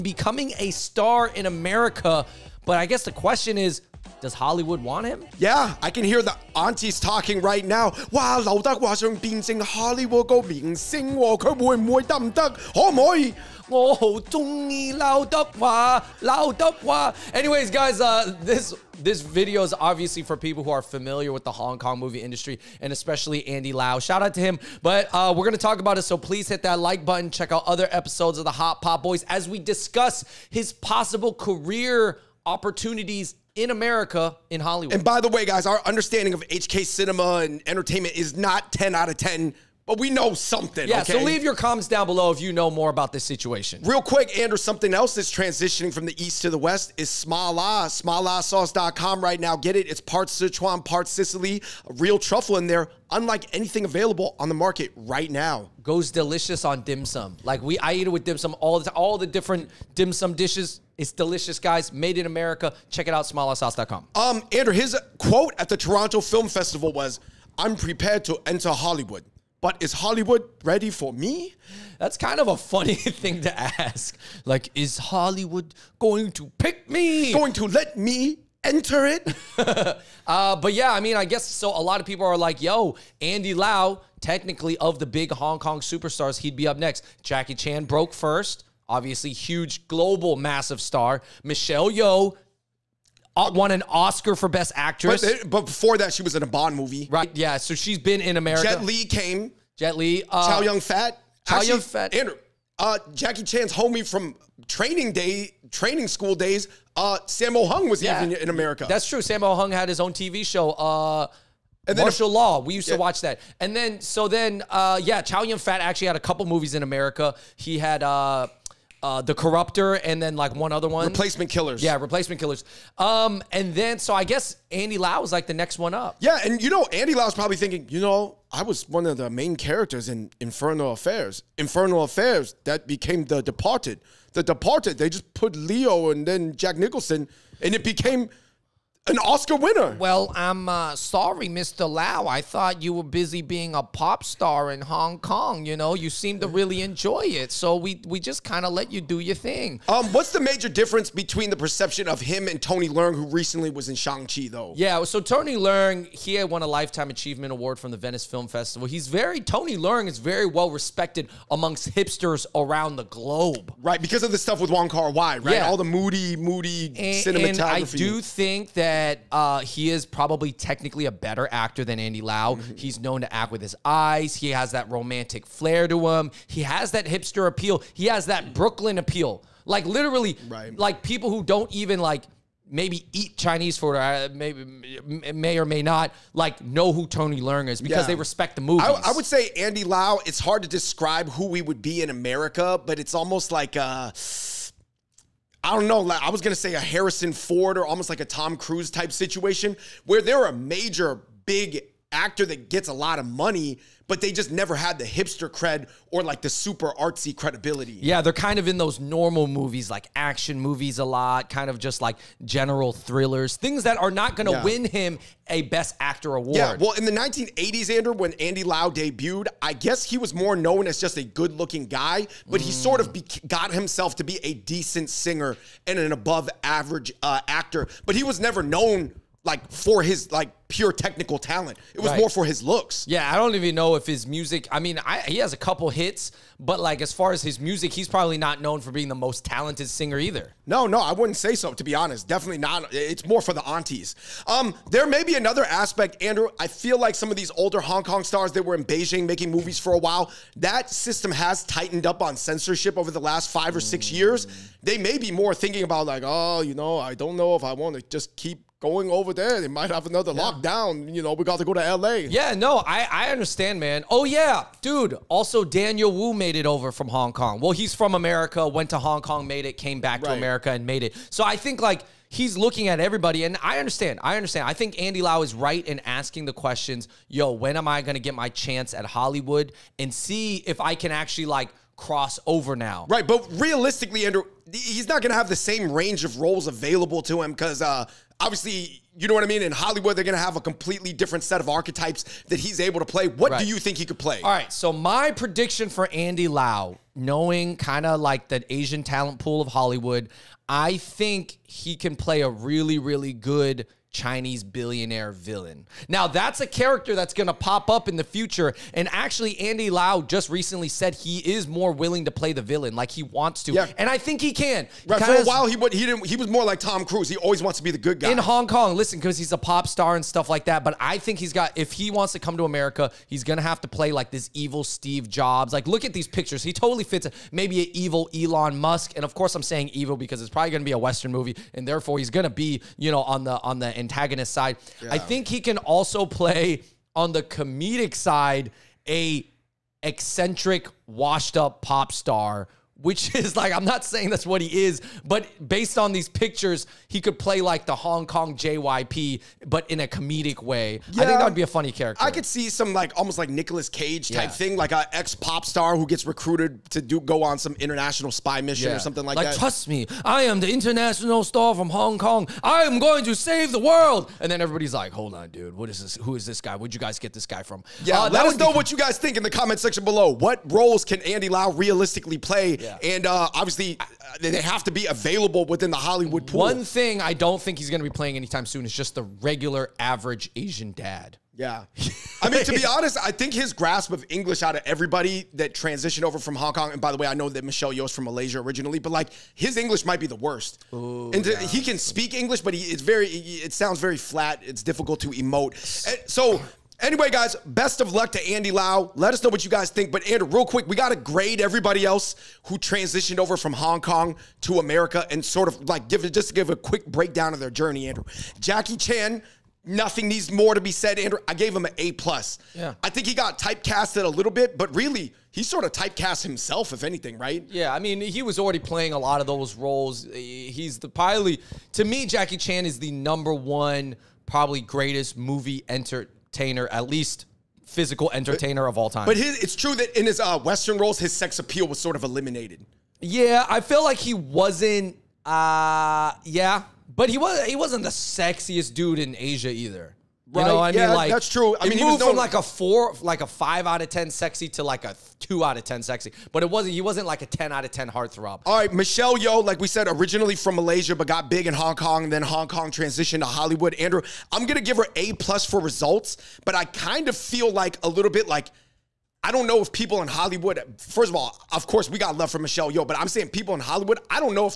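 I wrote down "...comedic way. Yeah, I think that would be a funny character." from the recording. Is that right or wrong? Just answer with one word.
right.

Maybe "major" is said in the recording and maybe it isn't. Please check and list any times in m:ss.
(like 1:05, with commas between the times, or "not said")
2:30, 3:20.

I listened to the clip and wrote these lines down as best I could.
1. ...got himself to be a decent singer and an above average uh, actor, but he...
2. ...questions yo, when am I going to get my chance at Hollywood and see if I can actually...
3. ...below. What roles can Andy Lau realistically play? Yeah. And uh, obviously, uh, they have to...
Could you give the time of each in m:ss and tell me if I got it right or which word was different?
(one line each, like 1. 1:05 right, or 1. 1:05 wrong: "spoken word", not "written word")
1. 3:43 right
2. 4:36 right
3. 6:10 right.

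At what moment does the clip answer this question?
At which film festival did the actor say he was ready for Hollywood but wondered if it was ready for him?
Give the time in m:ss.
1:05.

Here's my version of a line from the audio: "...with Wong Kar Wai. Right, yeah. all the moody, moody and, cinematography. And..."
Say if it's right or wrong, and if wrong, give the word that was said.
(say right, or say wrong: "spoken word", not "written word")
right.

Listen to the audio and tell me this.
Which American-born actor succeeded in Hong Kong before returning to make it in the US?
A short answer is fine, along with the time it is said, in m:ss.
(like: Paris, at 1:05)
Daniel Wu, at 4:25.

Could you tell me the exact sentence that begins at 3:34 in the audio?
win him a Best Actor award.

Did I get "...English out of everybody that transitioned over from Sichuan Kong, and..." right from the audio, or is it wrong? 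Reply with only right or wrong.
wrong.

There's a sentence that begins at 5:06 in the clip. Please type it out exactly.
Now, that's a character that's going to pop up in the future.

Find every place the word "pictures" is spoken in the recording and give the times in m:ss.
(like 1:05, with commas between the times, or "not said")
5:26, 5:46.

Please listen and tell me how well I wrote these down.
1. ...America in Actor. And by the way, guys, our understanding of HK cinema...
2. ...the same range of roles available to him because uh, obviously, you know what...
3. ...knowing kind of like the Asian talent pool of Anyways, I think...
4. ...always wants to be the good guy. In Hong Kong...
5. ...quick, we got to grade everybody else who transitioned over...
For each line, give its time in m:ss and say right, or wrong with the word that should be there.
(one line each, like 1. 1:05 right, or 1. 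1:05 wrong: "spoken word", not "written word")
1. 0:33 wrong: "Hollywood", not "Actor"
2. 4:45 right
3. 4:57 wrong: "Hollywood", not "Anyways"
4. 5:17 right
5. 6:40 right.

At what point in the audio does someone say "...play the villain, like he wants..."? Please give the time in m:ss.
5:12.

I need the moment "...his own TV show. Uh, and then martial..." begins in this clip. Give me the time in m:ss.
1:49.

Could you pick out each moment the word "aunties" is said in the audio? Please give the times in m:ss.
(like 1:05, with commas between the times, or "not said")
0:06, 4:03.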